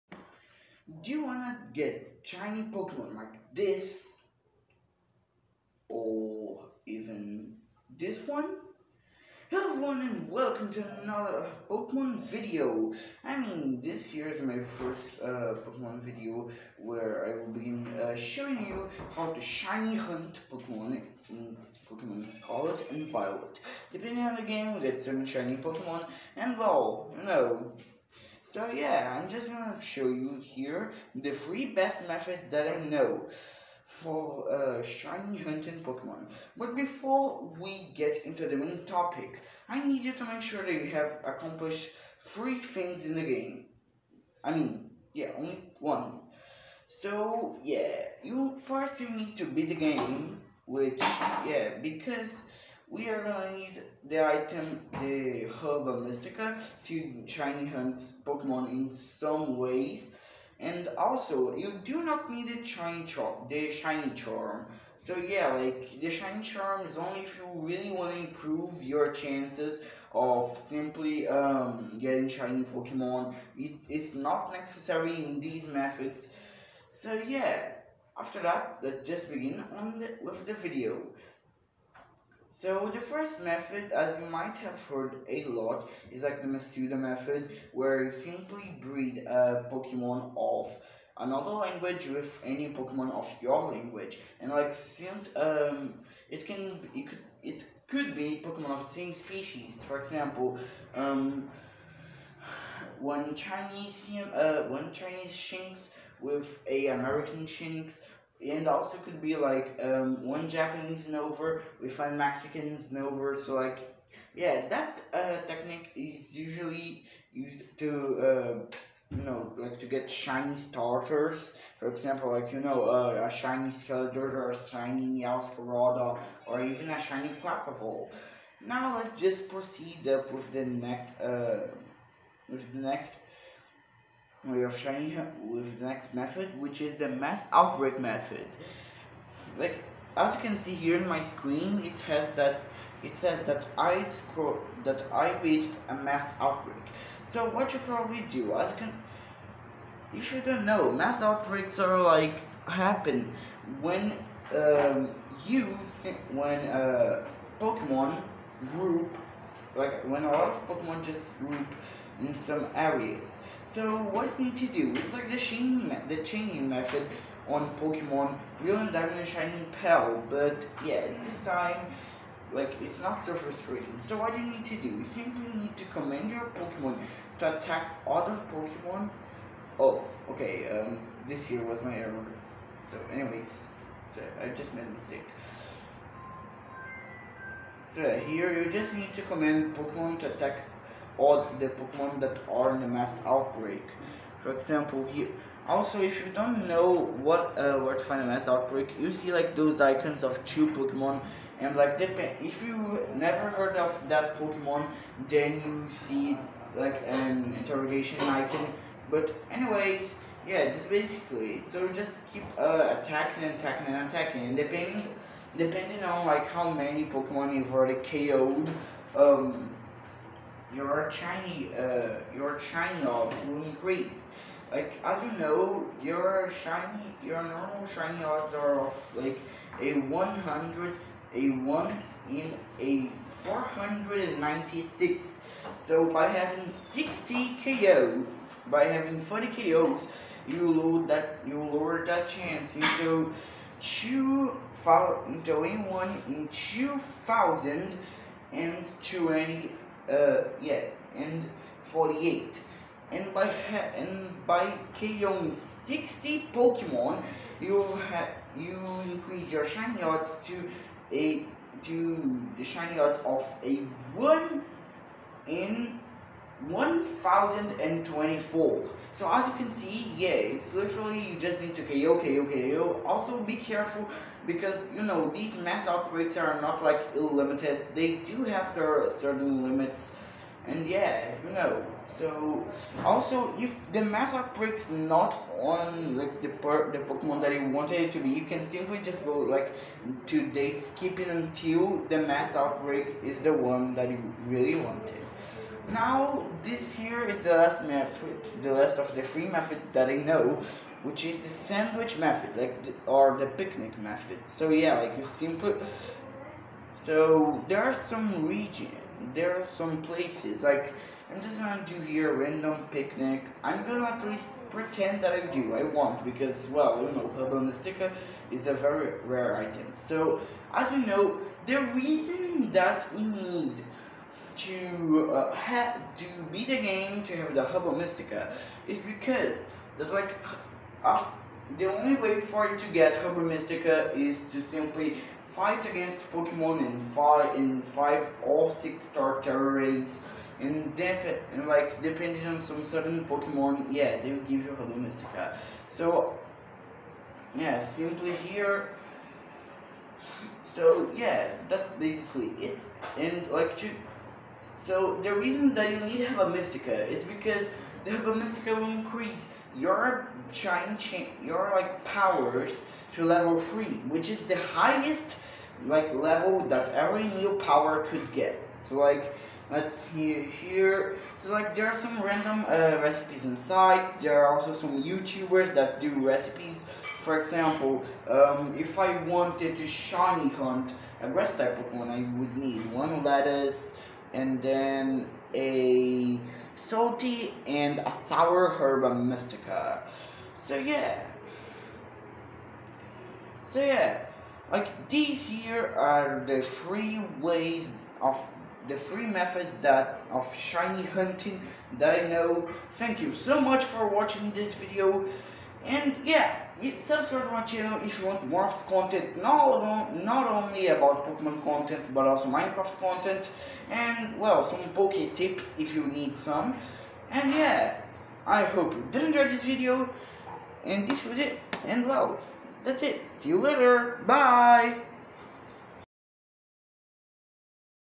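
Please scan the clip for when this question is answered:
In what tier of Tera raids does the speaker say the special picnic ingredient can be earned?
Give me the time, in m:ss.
5:37.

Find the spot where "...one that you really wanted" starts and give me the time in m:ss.
4:53.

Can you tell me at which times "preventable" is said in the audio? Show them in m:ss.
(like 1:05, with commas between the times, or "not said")
not said.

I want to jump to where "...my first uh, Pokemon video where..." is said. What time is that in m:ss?
0:14.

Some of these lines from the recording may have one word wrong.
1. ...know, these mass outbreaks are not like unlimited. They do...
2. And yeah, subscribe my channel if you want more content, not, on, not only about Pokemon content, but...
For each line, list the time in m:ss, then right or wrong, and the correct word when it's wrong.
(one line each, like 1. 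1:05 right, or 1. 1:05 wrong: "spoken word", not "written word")
1. 4:35 right
2. 6:45 right.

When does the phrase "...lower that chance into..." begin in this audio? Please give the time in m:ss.
4:01.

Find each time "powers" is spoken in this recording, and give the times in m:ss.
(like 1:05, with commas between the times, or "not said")
6:02, 6:07.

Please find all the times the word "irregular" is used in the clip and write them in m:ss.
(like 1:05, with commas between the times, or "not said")
not said.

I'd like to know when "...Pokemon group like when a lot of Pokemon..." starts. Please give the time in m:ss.
2:37.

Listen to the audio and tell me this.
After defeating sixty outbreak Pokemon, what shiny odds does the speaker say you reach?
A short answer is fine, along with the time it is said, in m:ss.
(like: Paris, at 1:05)
1 in 1024, at 4:24.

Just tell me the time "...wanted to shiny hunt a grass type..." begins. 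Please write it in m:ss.
6:19.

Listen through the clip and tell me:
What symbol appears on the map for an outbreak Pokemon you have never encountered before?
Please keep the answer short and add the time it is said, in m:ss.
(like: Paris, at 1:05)
Interrogation icon, at 3:27.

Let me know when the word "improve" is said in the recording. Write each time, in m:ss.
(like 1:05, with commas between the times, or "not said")
1:08.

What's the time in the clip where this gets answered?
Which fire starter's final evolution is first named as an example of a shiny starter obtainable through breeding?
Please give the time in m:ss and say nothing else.
2:03.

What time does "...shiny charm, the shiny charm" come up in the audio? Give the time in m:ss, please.
1:02.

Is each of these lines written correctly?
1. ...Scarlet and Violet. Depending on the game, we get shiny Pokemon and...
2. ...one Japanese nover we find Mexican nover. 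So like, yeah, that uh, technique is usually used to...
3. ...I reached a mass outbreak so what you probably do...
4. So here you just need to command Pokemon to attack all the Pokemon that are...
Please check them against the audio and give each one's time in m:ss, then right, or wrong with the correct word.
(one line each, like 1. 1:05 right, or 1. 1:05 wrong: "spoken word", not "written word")
1. 0:22 right
2. 1:50 right
3. 2:25 right
4. 3:07 right.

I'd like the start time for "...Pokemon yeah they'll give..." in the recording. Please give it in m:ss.
5:43.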